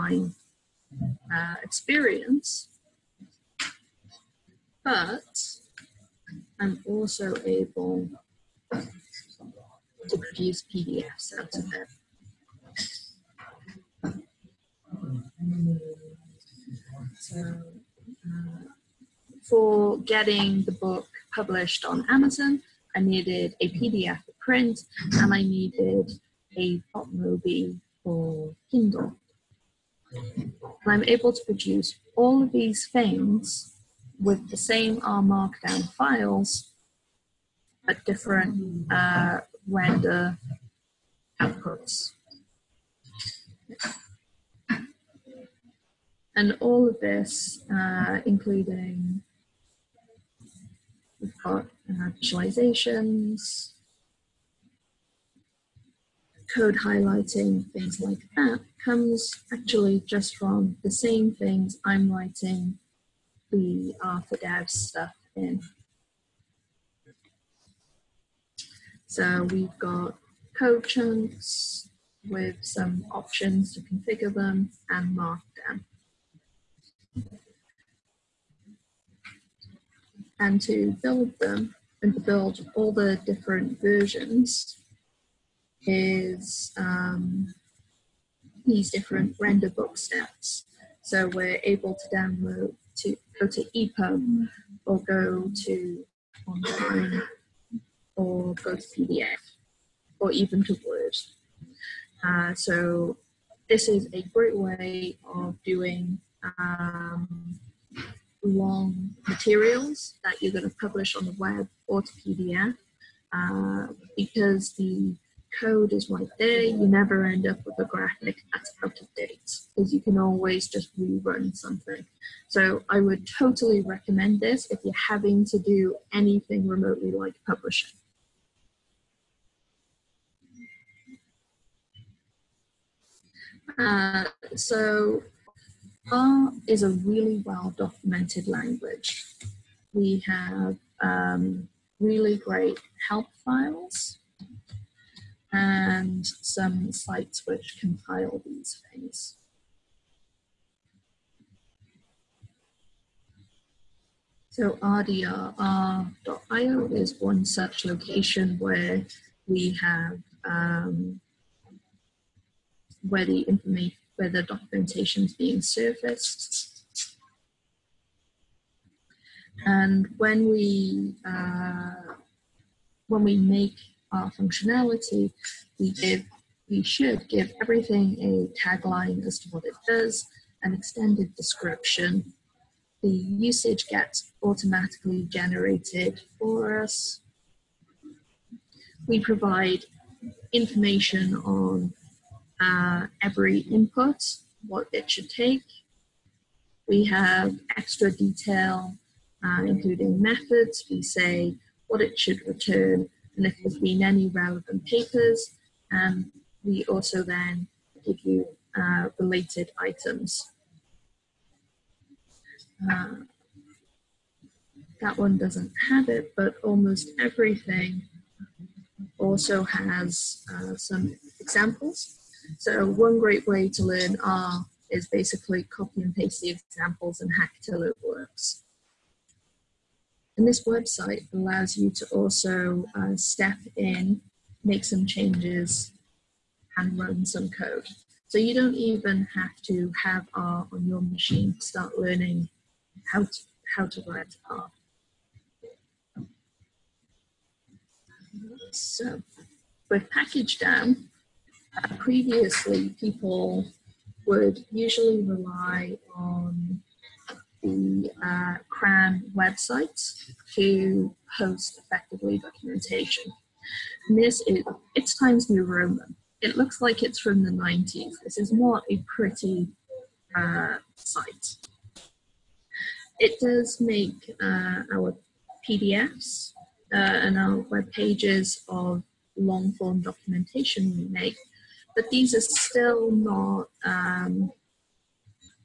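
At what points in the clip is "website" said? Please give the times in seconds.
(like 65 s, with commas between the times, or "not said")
230 s, 259 s.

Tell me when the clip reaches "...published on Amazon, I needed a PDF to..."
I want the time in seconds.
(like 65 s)
21 s.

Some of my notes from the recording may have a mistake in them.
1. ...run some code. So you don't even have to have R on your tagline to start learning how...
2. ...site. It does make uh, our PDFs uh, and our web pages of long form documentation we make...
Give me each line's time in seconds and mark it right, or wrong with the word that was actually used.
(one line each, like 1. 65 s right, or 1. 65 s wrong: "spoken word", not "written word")
1. 236 s wrong: "machine", not "tagline"
2. 270 s right.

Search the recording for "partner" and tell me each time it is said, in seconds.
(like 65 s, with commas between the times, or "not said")
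not said.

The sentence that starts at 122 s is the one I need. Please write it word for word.
So I would totally recommend this if you're having to do anything remotely like publishing.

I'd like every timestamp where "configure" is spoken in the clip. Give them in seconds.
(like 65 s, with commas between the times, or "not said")
73 s.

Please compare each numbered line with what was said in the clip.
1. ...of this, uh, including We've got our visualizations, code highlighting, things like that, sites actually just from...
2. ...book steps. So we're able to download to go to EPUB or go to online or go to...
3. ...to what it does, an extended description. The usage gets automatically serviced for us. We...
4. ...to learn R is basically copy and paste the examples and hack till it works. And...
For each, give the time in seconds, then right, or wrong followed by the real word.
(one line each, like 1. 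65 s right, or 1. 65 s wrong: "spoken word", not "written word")
1. 46 s wrong: "comes", not "sites"
2. 89 s right
3. 179 s wrong: "generated", not "serviced"
4. 223 s right.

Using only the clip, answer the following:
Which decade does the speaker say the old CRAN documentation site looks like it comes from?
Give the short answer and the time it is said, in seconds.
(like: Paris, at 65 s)
the 90s, at 267 s.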